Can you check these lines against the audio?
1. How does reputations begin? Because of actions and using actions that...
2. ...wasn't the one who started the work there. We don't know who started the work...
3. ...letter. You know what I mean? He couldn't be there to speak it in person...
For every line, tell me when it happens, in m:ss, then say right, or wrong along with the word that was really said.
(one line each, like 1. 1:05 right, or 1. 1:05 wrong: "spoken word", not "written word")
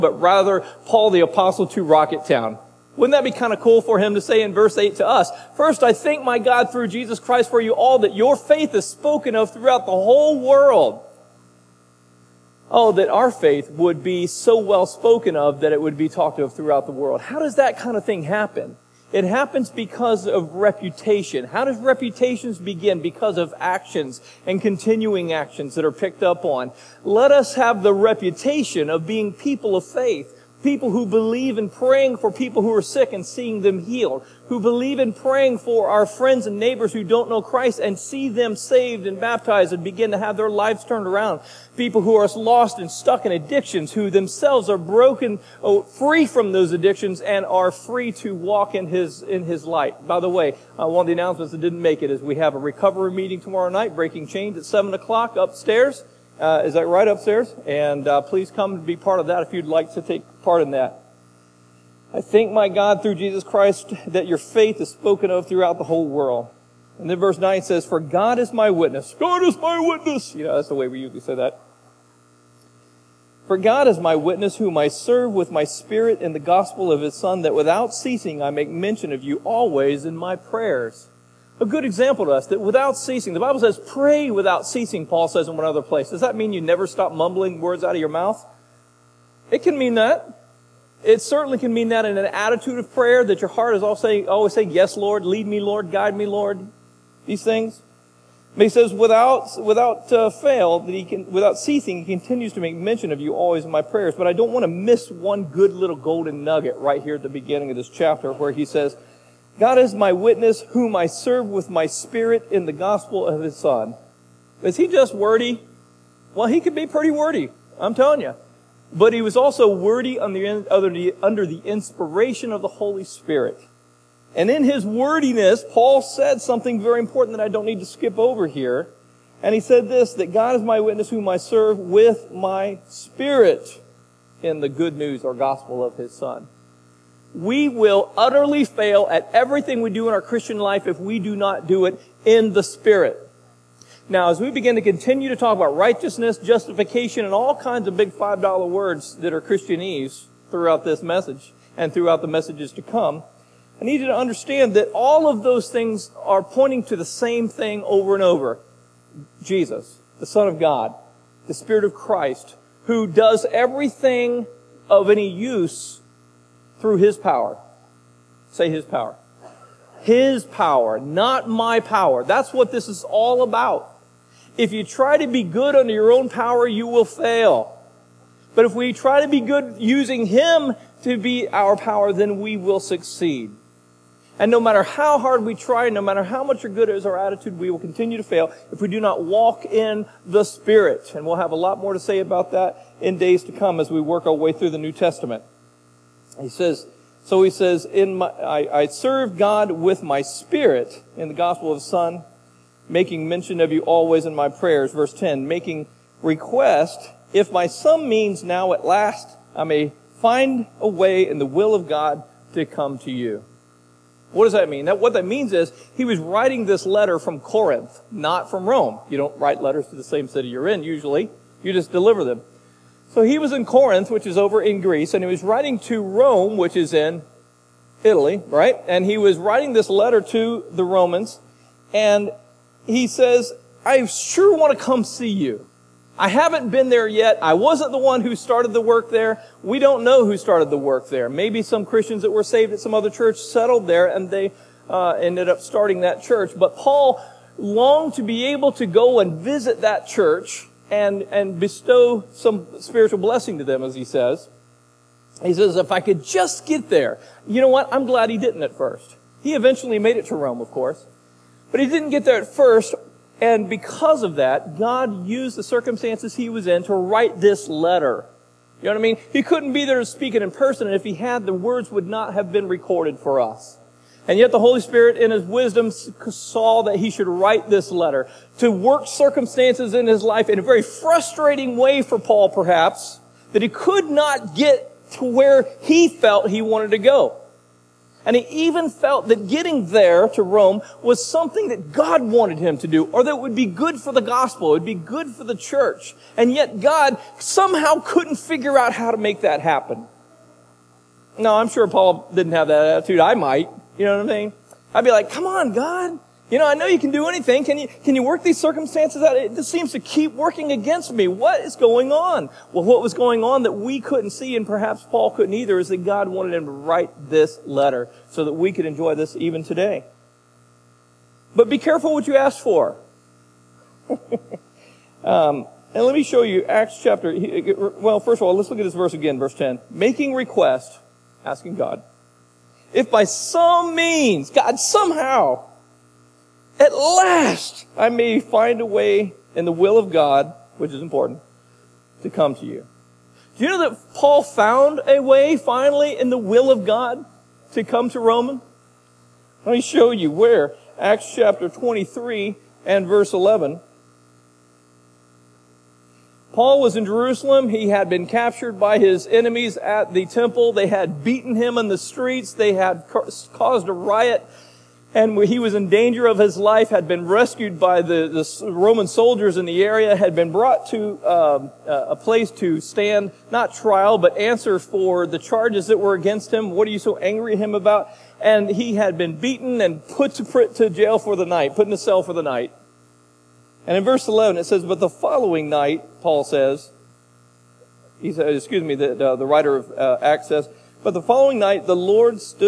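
1. 0:21 wrong: "continuing", not "using"
2. 3:57 right
3. 4:27 right.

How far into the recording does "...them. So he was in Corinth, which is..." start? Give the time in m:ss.
3:42.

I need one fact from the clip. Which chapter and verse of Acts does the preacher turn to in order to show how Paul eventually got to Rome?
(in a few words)
Acts 23:11.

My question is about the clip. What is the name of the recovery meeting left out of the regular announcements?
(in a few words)
Breaking Chains.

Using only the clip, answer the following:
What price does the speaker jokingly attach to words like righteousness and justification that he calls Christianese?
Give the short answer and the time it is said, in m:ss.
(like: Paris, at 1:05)
$5, at 2:28.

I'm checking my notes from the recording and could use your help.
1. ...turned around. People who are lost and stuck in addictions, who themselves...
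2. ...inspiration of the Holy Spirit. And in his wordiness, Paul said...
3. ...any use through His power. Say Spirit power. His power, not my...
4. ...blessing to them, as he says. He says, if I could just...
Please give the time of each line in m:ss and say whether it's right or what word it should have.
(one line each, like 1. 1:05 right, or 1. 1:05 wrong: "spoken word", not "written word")
1. 0:40 right
2. 2:01 right
3. 2:45 wrong: "His", not "Spirit"
4. 4:13 right.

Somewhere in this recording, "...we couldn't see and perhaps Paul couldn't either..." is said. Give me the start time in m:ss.
5:13.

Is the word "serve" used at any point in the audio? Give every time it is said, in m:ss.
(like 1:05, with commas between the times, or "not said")
1:14, 1:51, 2:11, 3:18.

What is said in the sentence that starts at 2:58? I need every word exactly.
But if we try to be good using Him to be our power, then we will succeed.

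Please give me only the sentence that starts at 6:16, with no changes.
What are you so angry at him about?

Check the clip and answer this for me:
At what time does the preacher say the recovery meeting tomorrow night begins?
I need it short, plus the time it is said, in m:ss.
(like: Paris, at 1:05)
7 o'clock, at 0:54.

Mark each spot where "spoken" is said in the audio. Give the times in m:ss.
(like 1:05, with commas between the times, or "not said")
0:08, 0:14, 1:04.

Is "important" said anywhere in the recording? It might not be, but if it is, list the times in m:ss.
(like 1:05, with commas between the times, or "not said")
2:07, 5:41.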